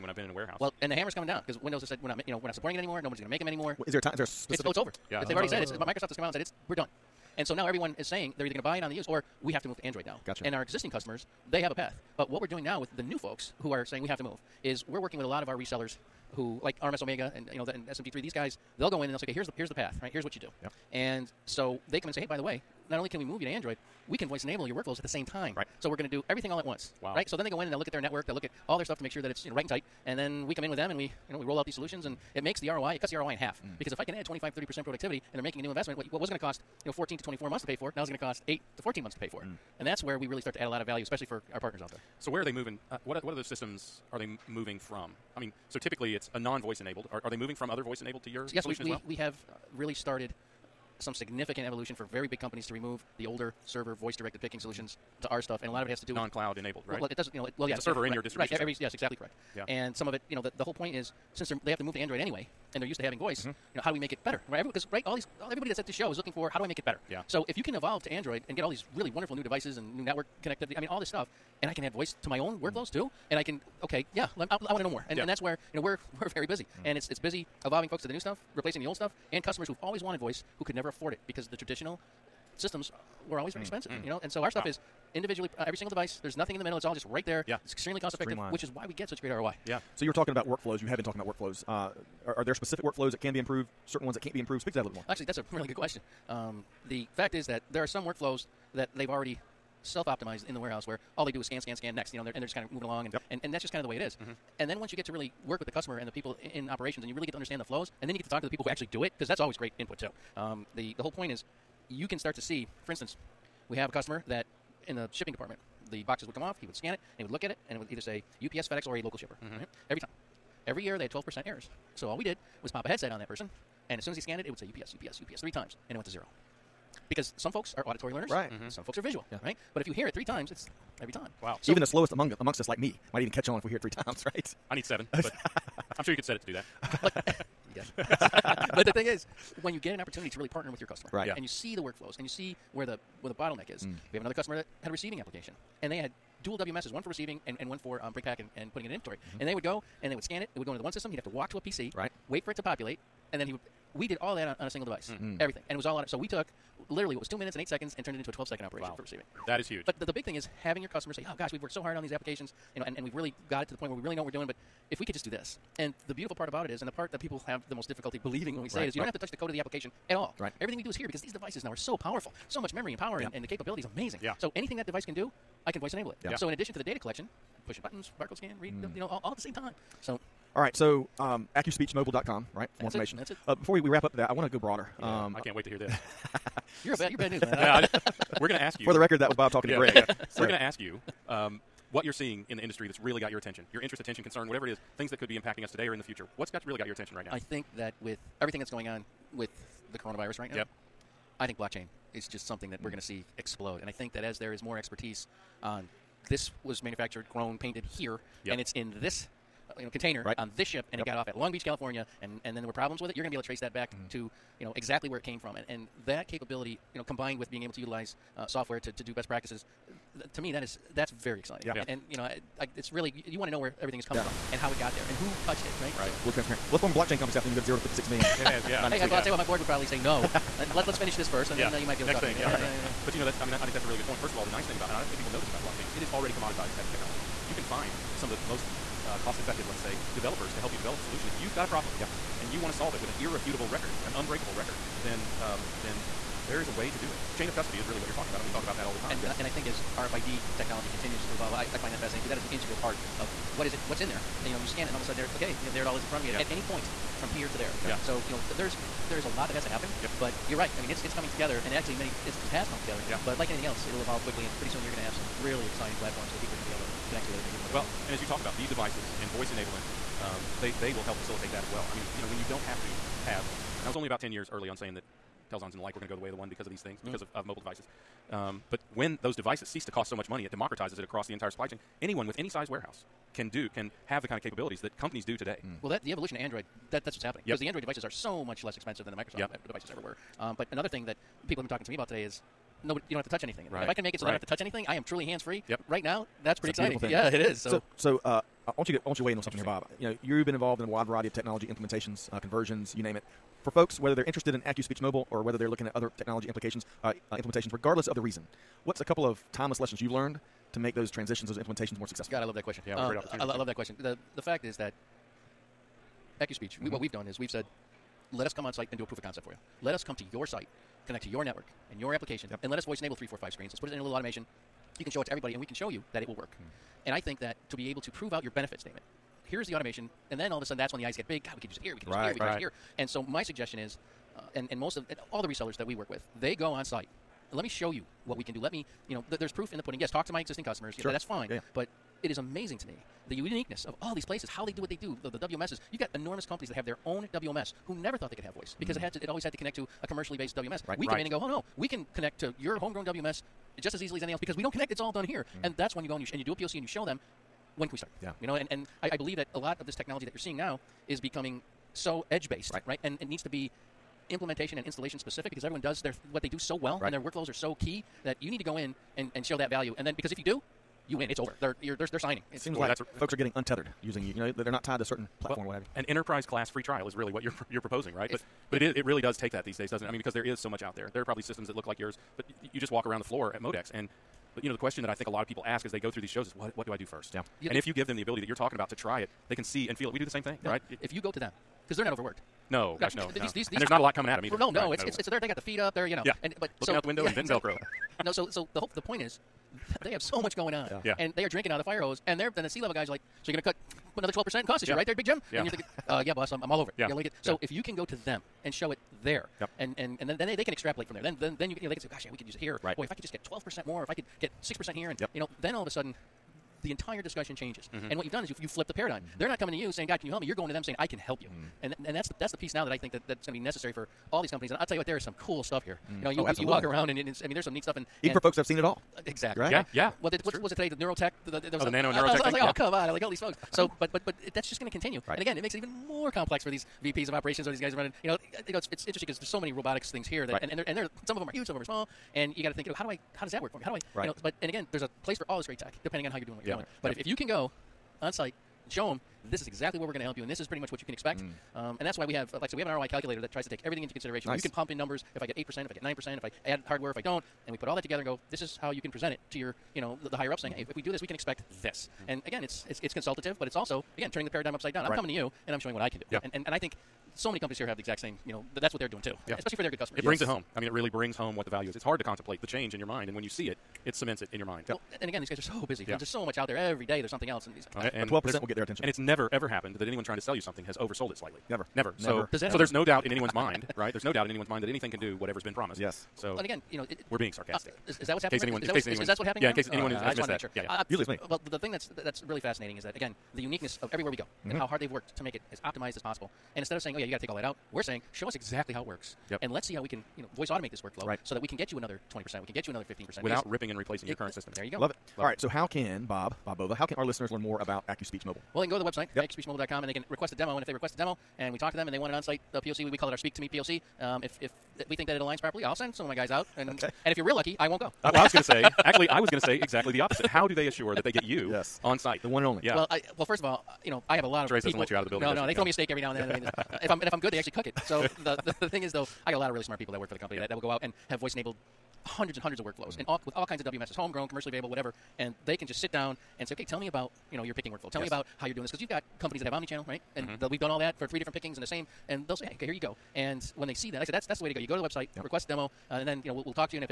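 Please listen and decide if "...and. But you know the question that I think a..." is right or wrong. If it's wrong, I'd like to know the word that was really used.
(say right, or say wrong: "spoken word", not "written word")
right.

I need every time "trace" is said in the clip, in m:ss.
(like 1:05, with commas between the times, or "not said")
3:33, 8:44.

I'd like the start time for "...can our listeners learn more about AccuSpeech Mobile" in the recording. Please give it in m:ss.
8:27.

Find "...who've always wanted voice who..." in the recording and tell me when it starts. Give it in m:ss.
1:19.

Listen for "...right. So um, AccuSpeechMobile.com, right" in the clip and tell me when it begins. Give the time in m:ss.
3:00.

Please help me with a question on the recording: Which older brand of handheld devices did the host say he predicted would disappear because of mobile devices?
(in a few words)
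Telxons.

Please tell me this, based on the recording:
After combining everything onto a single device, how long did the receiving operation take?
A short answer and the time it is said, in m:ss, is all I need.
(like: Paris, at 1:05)
12 seconds, at 2:38.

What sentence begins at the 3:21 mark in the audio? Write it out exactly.
I think blockchain is just something that mm.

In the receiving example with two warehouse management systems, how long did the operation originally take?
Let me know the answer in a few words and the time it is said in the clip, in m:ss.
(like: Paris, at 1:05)
2 minutes 8 seconds, at 2:37.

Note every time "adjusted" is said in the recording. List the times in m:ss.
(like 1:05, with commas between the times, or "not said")
not said.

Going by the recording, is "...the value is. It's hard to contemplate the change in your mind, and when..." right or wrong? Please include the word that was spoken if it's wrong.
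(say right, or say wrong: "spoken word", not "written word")
right.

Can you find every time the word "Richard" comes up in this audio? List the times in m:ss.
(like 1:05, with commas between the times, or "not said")
not said.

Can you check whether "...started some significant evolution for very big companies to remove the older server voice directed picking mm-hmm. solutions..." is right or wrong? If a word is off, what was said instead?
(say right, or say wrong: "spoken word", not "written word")
right.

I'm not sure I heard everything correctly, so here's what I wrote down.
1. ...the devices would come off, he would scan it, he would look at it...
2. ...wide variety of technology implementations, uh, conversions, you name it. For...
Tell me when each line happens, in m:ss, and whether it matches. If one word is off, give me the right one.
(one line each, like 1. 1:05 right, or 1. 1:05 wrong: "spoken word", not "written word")
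1. 1:55 wrong: "boxes", not "devices"
2. 5:00 right.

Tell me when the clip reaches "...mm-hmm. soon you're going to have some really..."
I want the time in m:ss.
4:24.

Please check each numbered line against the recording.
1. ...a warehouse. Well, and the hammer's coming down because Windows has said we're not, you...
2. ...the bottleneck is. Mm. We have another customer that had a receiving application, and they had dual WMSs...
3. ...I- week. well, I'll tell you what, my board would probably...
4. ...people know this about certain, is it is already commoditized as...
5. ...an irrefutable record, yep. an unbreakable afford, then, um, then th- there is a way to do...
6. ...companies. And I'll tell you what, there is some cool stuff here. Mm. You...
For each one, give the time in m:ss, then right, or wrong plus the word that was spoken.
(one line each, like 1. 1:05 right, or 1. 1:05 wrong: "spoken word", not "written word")
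1. 0:00 right
2. 2:23 right
3. 3:49 right
4. 3:55 wrong: "blockchain", not "certain"
5. 4:03 wrong: "record", not "afford"
6. 7:04 right.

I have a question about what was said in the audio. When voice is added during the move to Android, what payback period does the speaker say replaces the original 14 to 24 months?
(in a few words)
8 to 14 months.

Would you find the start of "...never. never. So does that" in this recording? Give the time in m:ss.
8:01.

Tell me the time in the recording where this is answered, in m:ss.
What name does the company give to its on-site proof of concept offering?
8:33.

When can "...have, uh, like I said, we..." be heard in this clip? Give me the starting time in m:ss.
7:32.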